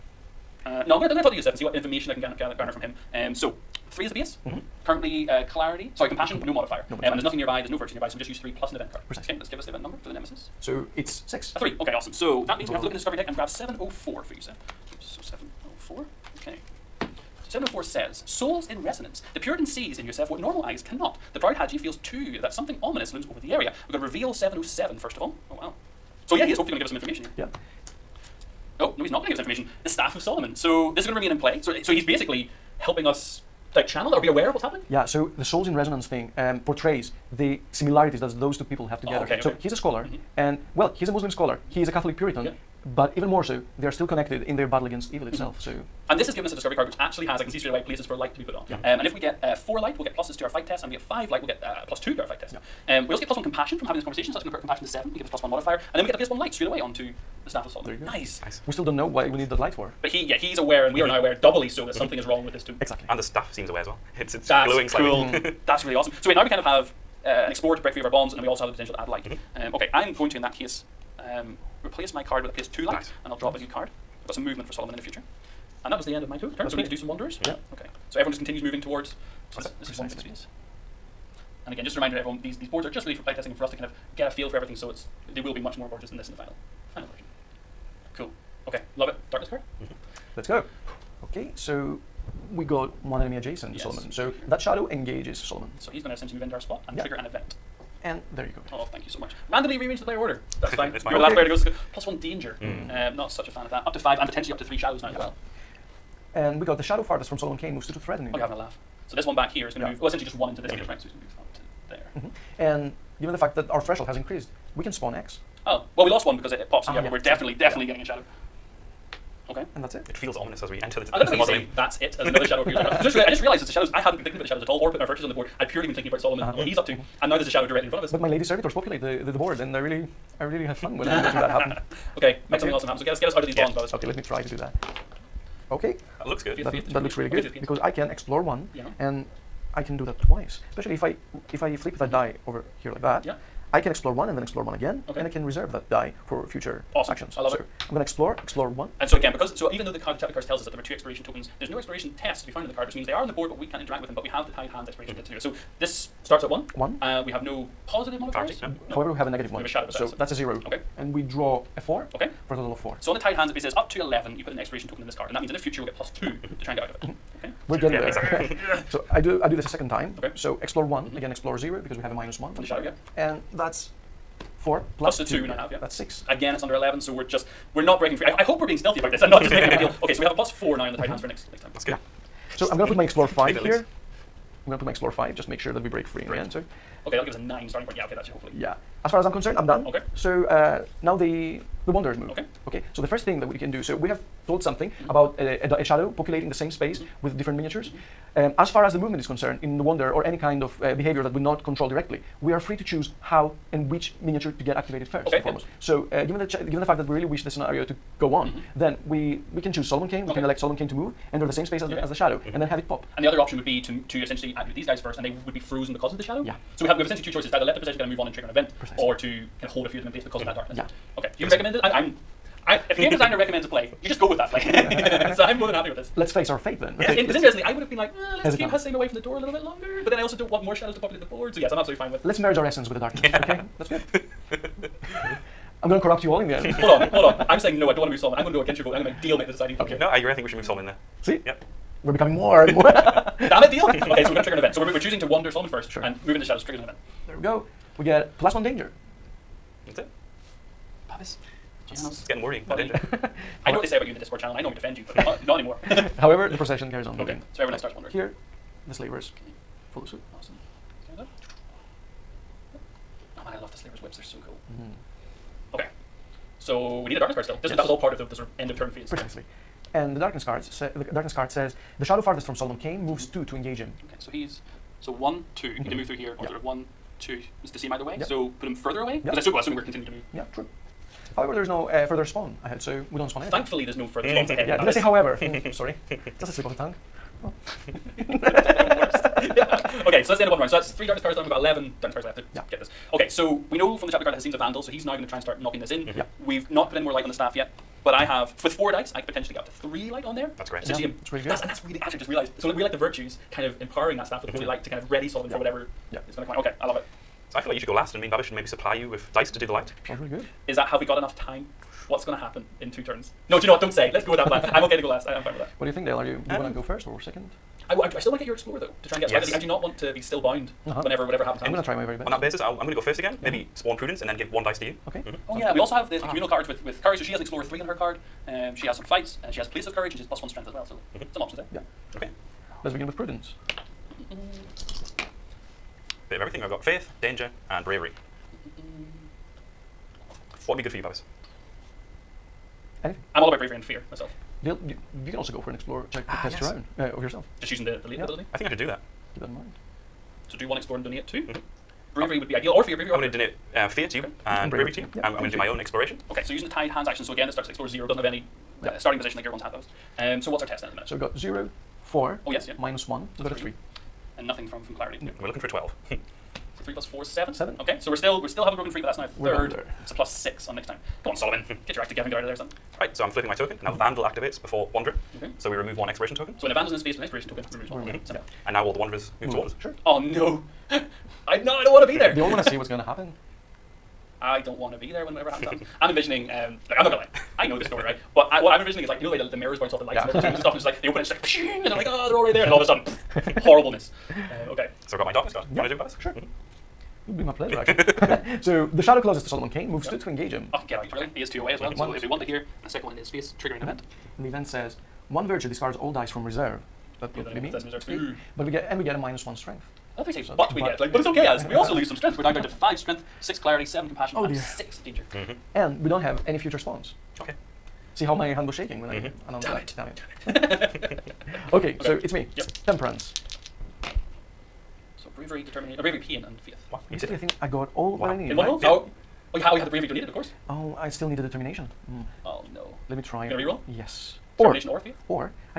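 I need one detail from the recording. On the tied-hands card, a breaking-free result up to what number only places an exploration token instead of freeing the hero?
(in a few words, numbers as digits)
11.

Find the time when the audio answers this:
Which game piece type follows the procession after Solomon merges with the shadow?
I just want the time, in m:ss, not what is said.
4:18.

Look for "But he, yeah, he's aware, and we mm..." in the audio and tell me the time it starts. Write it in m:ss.
1:00.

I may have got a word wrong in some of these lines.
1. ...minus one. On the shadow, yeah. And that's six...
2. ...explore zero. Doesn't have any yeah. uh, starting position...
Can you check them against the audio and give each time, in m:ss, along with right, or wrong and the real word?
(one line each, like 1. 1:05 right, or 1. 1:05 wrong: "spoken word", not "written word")
1. 2:52 wrong: "four", not "six"
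2. 5:57 right.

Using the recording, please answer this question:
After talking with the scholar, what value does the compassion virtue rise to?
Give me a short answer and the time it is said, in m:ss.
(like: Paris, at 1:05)
7, at 0:54.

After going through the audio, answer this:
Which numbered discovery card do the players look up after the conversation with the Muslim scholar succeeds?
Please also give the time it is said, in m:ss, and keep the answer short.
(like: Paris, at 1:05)
704, at 0:13.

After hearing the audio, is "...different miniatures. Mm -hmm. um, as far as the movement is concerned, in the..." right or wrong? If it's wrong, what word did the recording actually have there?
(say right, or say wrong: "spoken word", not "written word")
right.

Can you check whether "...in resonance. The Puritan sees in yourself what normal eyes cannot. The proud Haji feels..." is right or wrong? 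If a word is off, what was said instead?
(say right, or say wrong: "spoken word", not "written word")
right.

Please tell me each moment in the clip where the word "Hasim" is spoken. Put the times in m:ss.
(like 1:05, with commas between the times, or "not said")
3:48, 4:54.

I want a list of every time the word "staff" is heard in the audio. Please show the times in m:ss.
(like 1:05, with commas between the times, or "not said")
0:29, 0:57, 1:03, 4:57, 5:04.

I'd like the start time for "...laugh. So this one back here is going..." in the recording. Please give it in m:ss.
1:48.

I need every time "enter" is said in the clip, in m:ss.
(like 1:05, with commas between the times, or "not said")
2:00, 3:31.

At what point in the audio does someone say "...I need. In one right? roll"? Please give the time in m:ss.
7:08.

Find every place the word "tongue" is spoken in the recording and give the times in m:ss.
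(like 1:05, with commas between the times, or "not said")
4:46.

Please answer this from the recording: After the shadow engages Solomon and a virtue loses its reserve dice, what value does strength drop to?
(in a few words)
5.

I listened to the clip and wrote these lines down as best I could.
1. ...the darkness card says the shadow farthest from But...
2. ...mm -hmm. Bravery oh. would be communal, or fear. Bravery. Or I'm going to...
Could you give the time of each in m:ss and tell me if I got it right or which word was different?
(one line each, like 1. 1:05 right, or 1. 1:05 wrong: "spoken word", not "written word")
1. 4:30 wrong: "Solomon", not "But"
2. 5:51 wrong: "ideal", not "communal".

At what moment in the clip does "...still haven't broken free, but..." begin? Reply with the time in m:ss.
6:08.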